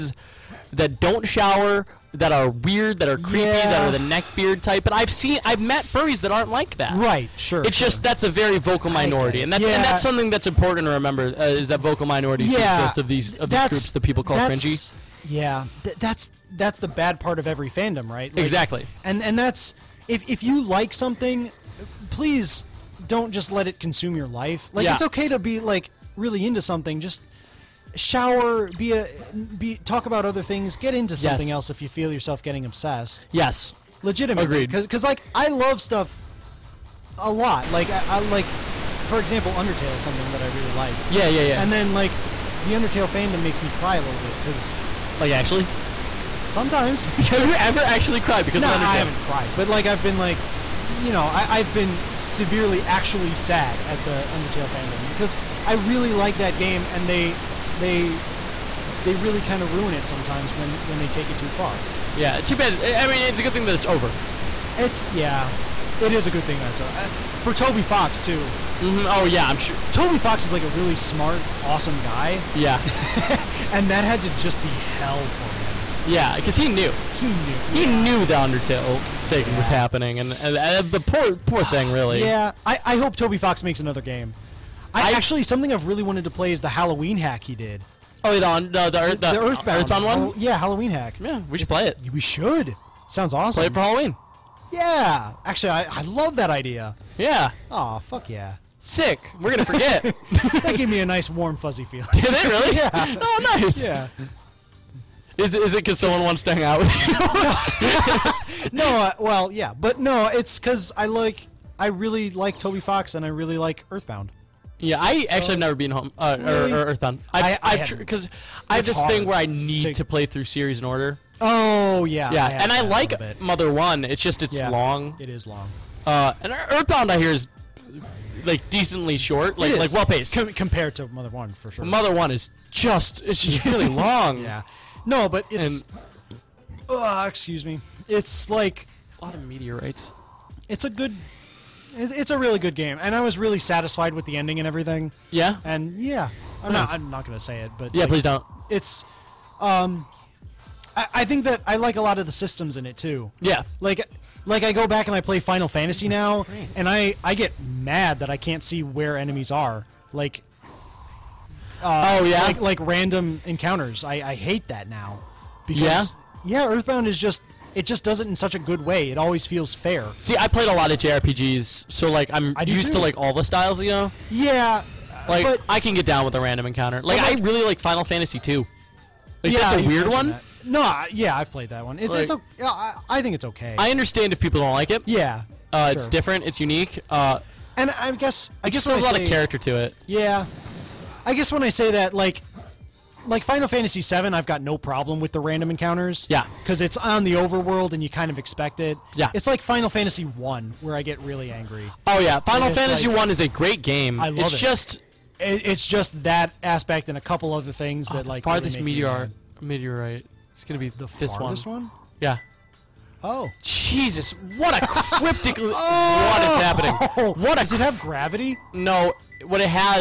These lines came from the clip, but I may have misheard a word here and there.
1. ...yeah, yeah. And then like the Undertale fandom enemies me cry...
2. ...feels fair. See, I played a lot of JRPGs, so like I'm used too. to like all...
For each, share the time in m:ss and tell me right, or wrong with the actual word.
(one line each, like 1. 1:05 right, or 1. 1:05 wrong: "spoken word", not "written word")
1. 0:41 wrong: "makes", not "enemies"
2. 2:49 right.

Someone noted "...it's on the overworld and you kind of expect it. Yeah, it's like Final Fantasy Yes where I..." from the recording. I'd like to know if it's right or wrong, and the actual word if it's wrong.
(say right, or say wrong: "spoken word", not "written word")
wrong: "One", not "Yes".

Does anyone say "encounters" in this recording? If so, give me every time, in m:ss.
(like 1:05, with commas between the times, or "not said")
2:43, 2:56, 3:15.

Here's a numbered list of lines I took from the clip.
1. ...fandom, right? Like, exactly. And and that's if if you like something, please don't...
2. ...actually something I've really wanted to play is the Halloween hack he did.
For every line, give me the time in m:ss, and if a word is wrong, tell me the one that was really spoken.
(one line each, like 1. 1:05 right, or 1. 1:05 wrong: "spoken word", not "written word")
1. 0:17 right
2. 1:25 right.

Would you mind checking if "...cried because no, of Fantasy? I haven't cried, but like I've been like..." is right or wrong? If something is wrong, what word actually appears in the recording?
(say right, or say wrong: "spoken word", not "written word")
wrong: "Undertale", not "Fantasy".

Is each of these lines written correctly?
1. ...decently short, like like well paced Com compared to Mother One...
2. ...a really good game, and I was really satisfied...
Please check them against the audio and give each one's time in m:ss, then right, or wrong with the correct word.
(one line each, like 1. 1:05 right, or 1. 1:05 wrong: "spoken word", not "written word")
1. 2:08 right
2. 2:22 right.